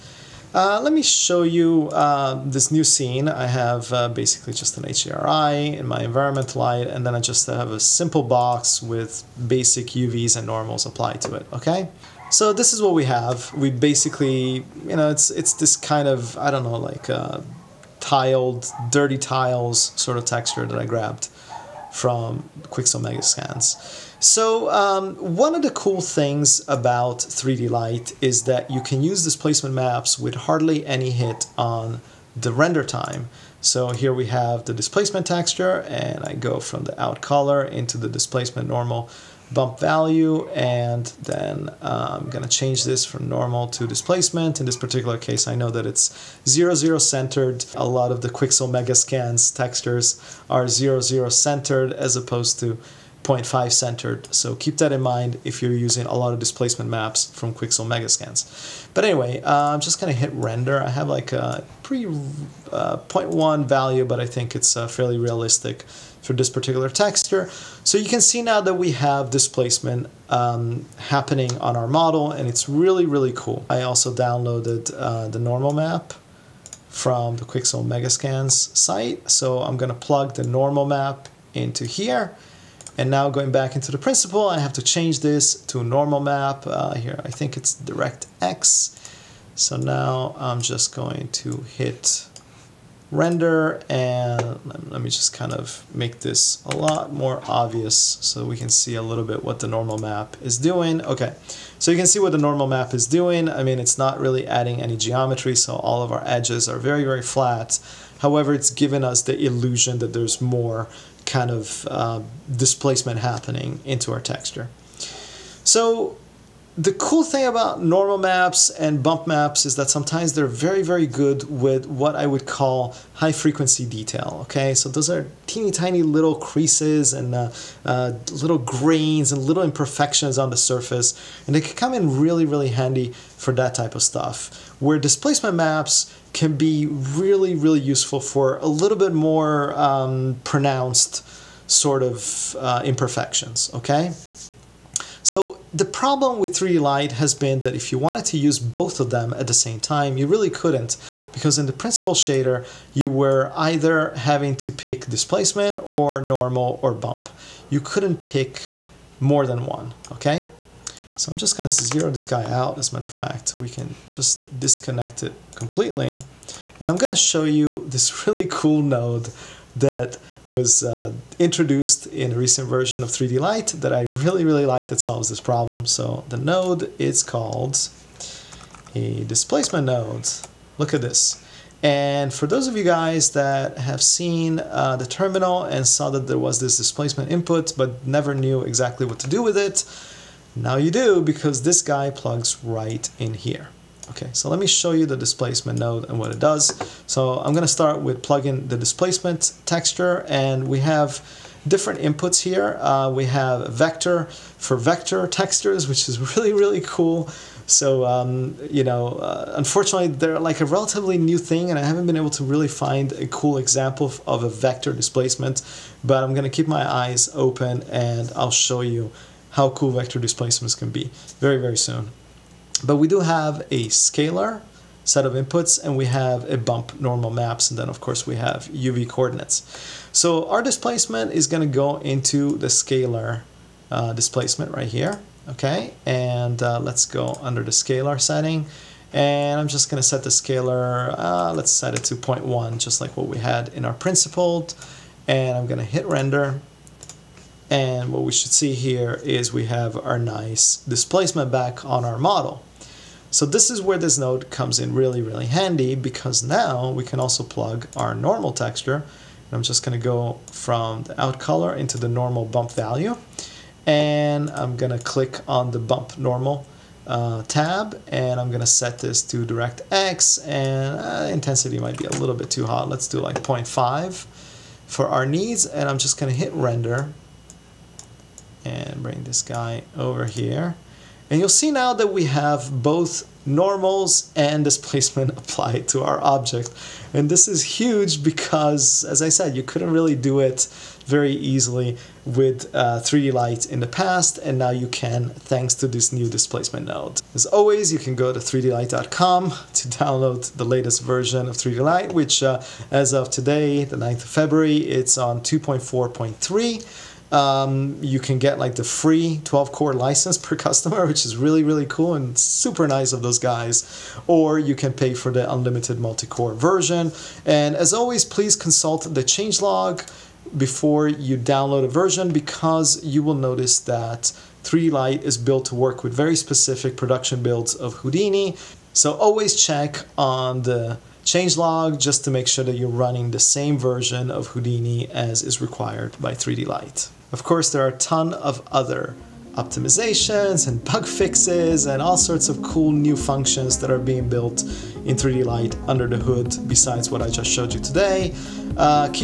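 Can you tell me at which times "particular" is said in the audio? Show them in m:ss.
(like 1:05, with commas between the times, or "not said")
0:44, 1:06.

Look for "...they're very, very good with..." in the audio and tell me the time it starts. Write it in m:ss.
2:00.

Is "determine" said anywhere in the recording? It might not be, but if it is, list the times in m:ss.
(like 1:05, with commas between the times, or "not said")
not said.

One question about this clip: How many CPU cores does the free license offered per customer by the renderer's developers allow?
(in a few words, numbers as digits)
12.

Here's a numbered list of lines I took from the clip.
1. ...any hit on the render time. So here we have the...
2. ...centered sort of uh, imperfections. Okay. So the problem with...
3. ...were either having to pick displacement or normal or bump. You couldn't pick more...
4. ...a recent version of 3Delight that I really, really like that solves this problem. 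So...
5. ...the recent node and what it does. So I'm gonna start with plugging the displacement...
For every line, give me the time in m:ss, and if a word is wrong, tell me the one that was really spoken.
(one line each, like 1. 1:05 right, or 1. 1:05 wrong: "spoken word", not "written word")
1. 0:30 right
2. 2:20 wrong: "pronounced", not "centered"
3. 2:33 right
4. 2:52 right
5. 3:15 wrong: "displacement", not "recent".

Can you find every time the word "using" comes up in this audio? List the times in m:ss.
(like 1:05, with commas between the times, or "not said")
0:55.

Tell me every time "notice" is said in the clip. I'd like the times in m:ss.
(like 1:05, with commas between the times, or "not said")
5:23.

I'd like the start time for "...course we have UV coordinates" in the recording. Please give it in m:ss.
3:48.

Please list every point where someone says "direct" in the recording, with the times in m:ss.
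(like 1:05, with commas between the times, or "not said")
1:27, 4:29.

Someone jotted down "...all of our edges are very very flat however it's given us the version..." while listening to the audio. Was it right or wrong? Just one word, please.
wrong.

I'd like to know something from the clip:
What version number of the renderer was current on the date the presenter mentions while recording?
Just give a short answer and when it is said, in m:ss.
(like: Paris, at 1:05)
2.4.3, at 5:05.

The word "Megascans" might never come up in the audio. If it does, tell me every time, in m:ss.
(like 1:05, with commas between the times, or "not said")
0:23, 0:48, 0:57, 1:17.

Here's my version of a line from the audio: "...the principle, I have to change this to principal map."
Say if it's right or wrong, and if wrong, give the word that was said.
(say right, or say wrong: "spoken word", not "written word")
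wrong: "normal", not "principal".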